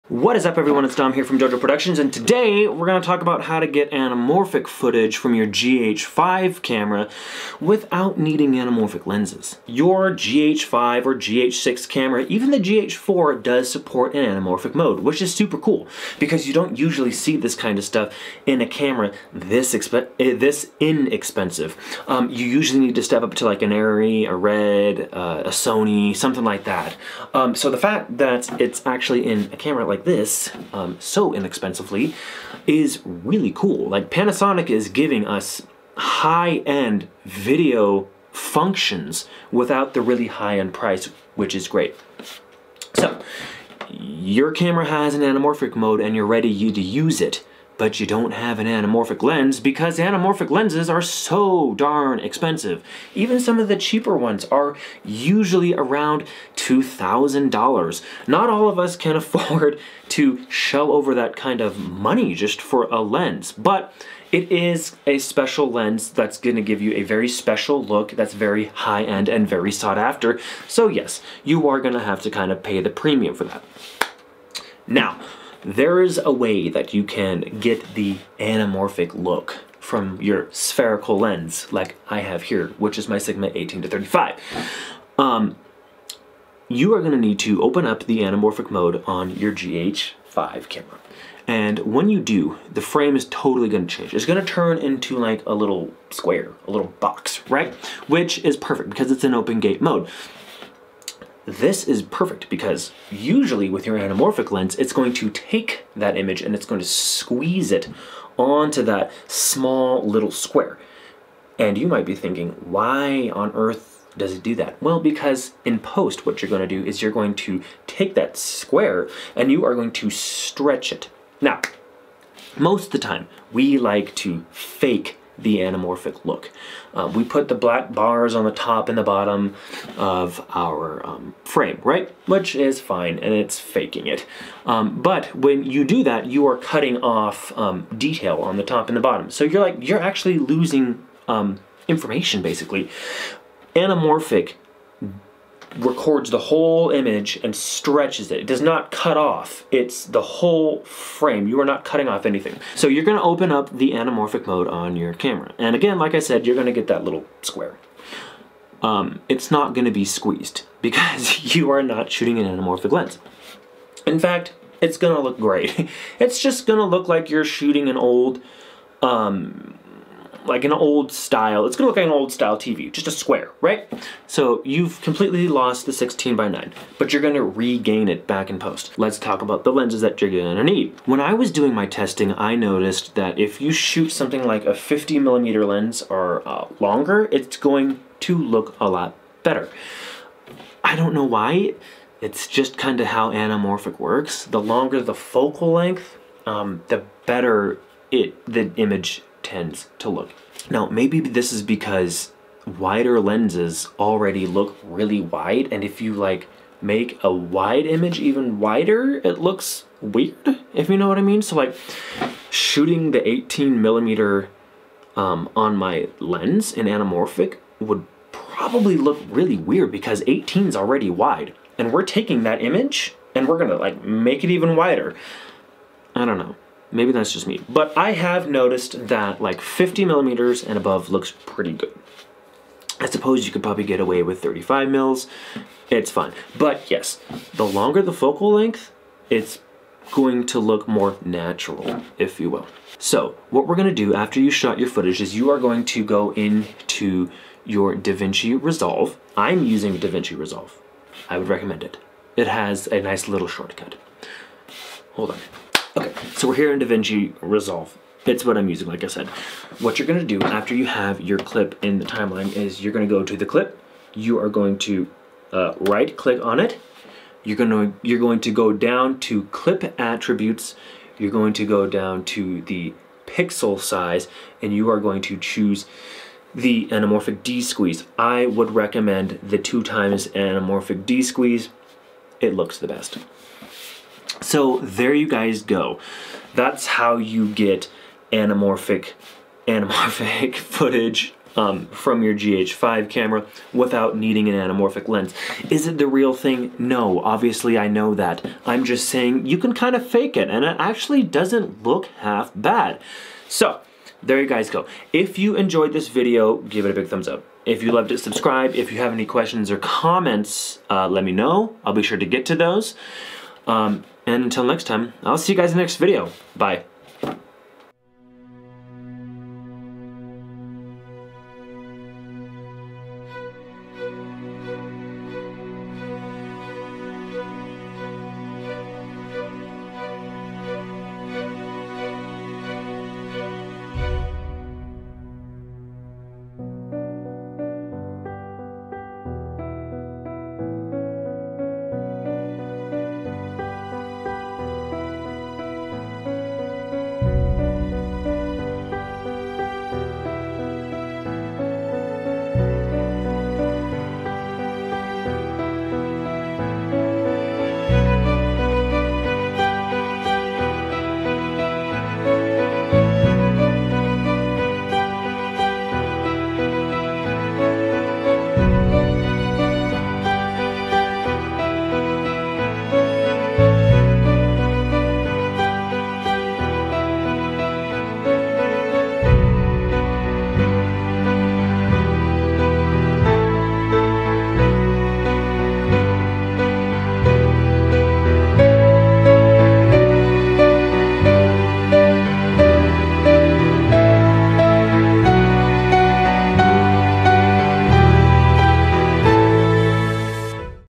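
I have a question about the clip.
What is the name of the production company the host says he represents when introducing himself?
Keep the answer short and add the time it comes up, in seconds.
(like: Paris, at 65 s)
Jo Jo Productions, at 1 s.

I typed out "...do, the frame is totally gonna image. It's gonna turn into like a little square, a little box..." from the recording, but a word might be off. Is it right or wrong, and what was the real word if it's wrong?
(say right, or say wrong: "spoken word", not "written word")
wrong: "change", not "image".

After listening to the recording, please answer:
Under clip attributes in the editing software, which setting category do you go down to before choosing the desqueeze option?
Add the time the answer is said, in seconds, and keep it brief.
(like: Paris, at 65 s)
pixel size, at 273 s.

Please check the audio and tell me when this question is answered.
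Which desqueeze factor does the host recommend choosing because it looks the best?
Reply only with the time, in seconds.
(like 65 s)
279 s.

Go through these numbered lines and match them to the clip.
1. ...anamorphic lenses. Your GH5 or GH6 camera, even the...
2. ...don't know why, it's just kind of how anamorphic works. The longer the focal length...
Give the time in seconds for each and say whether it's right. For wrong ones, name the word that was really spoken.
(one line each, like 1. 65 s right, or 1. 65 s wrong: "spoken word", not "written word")
1. 8 s right
2. 190 s right.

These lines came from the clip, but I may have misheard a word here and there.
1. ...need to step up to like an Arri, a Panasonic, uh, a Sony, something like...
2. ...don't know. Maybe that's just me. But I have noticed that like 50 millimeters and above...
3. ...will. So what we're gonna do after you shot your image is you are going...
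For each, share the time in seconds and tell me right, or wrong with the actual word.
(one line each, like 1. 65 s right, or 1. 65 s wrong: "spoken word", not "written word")
1. 22 s wrong: "Red", not "Panasonic"
2. 226 s right
3. 242 s wrong: "footage", not "image".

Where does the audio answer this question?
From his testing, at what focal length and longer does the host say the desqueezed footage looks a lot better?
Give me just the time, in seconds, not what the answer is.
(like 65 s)
184 s.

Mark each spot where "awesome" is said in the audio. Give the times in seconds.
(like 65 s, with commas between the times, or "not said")
not said.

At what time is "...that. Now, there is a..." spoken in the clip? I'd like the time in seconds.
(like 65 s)
73 s.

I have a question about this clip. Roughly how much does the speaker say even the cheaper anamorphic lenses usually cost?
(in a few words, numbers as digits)
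$2,000.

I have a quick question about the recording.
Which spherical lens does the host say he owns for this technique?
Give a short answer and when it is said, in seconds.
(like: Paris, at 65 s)
Sigma 18 to 35, at 83 s.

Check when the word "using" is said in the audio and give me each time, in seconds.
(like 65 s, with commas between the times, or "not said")
249 s, 258 s.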